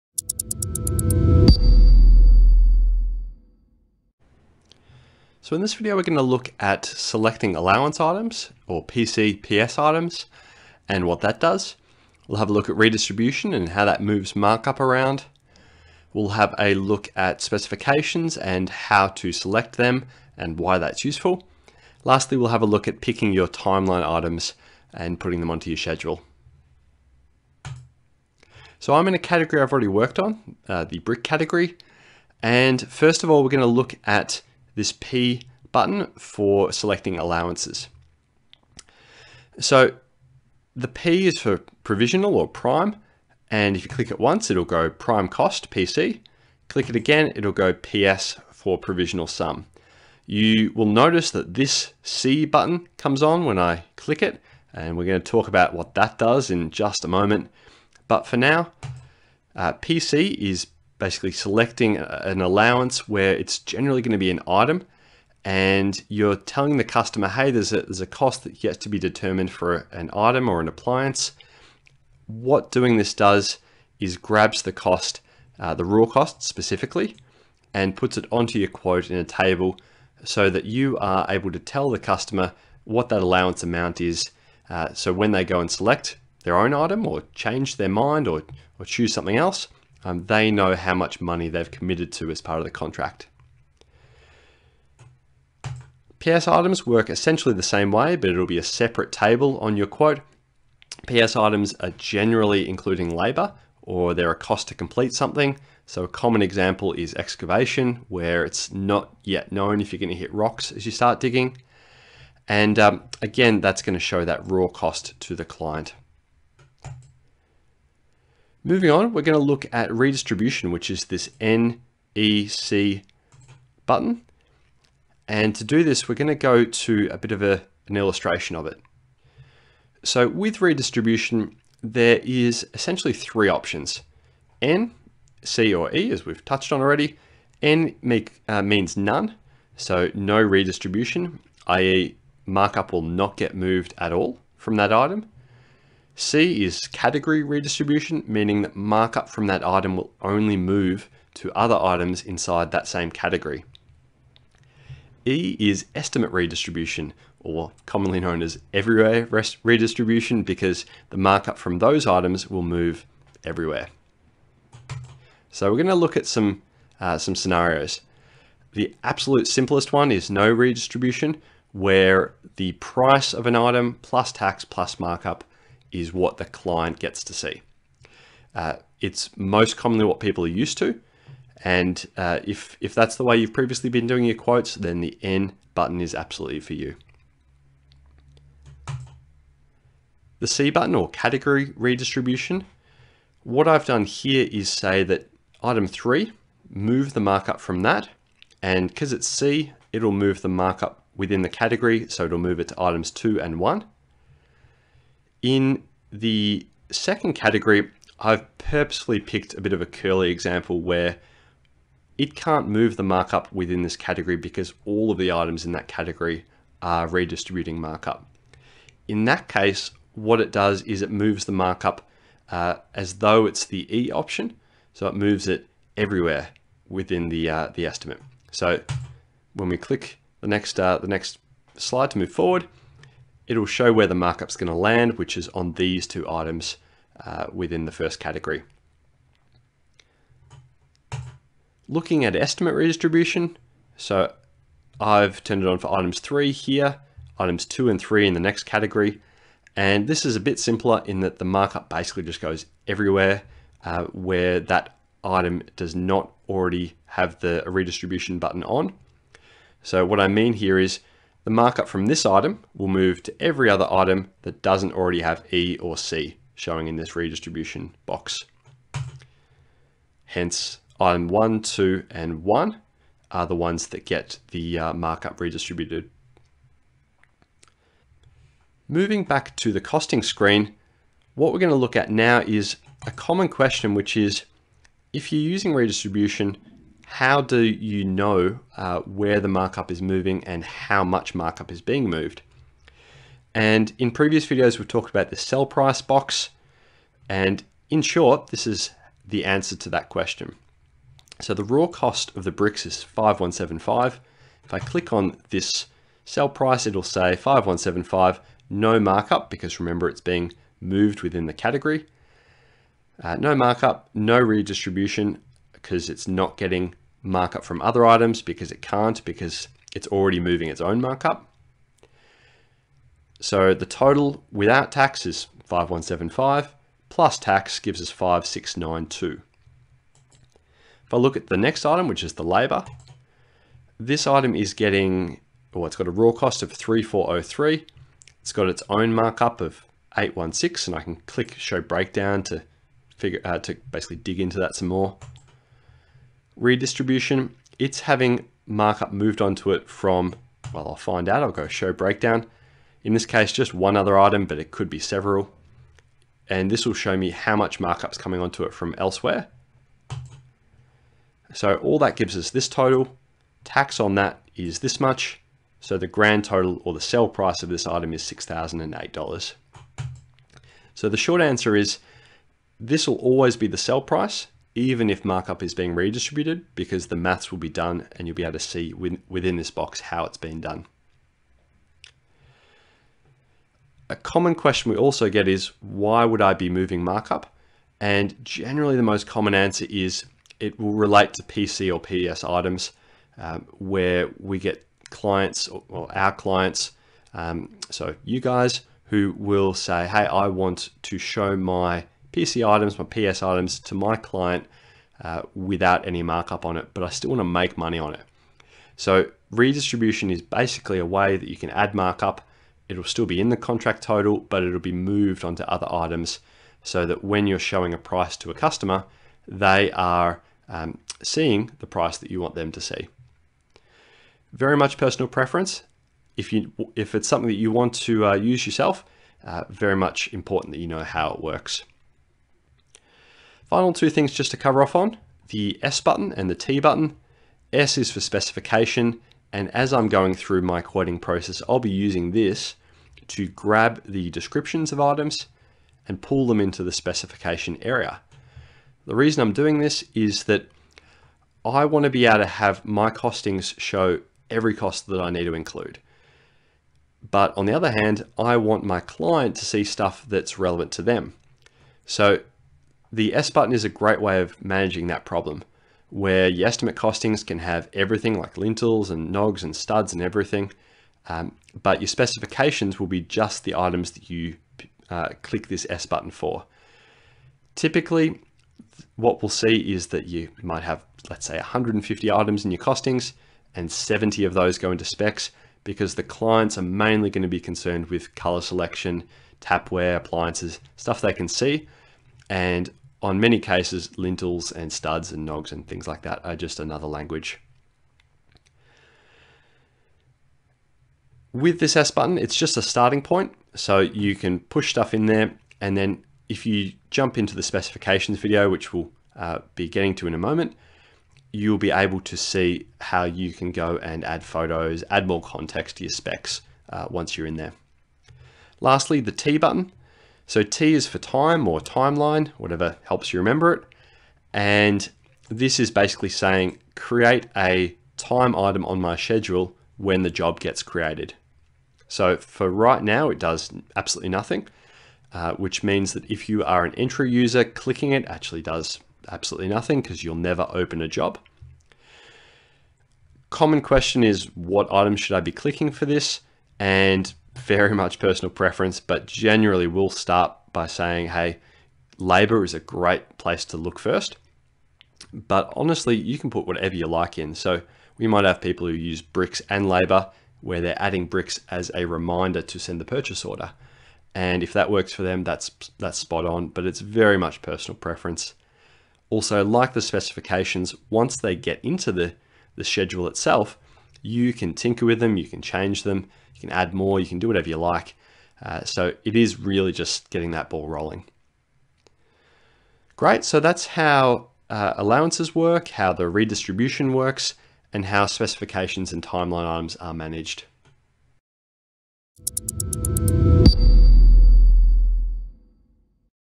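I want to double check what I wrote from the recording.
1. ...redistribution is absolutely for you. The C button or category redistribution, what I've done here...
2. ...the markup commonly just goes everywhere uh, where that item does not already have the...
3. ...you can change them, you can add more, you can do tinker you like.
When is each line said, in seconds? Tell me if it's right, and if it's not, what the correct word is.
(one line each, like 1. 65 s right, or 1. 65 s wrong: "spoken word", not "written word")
1. 185 s wrong: "button", not "redistribution"
2. 251 s wrong: "basically", not "commonly"
3. 575 s wrong: "whatever", not "tinker".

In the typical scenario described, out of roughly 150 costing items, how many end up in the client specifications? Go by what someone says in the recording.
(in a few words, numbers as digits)
70.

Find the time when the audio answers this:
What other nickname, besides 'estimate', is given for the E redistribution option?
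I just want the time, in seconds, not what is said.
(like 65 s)
158 s.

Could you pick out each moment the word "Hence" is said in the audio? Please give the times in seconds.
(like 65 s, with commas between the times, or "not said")
270 s.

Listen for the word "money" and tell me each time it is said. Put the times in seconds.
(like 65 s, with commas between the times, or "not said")
91 s, 407 s.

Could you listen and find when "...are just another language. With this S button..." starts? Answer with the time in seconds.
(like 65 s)
496 s.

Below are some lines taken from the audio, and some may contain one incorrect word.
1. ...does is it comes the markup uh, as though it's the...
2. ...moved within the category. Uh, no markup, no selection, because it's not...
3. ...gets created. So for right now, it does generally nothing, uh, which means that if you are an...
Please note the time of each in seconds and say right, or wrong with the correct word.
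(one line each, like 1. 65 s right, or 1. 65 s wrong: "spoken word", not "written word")
1. 220 s wrong: "moves", not "comes"
2. 310 s wrong: "redistribution", not "selection"
3. 530 s wrong: "absolutely", not "generally".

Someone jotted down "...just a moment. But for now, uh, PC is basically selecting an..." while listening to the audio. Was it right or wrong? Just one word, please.
right.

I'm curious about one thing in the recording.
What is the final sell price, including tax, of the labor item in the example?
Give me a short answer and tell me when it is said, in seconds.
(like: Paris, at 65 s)
$6,008, at 368 s.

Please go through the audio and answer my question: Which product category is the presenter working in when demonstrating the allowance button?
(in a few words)
Brick.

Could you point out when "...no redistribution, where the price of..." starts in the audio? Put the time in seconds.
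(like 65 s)
170 s.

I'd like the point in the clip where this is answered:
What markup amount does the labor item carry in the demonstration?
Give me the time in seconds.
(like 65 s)
340 s.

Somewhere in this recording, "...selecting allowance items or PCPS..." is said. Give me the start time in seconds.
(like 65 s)
6 s.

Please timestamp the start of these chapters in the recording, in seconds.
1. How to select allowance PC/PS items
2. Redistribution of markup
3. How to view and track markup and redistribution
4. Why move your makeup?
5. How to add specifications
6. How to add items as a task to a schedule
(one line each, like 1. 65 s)
1. 30 s
2. 117 s
3. 278 s
4. 385 s
5. 430 s
6. 519 s.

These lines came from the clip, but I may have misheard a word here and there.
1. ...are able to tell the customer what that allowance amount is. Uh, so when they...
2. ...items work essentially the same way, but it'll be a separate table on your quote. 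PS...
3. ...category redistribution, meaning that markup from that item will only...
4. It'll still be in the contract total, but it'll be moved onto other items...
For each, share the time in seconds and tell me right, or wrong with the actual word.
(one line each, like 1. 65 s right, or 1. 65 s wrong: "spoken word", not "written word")
1. 80 s right
2. 96 s right
3. 146 s right
4. 412 s right.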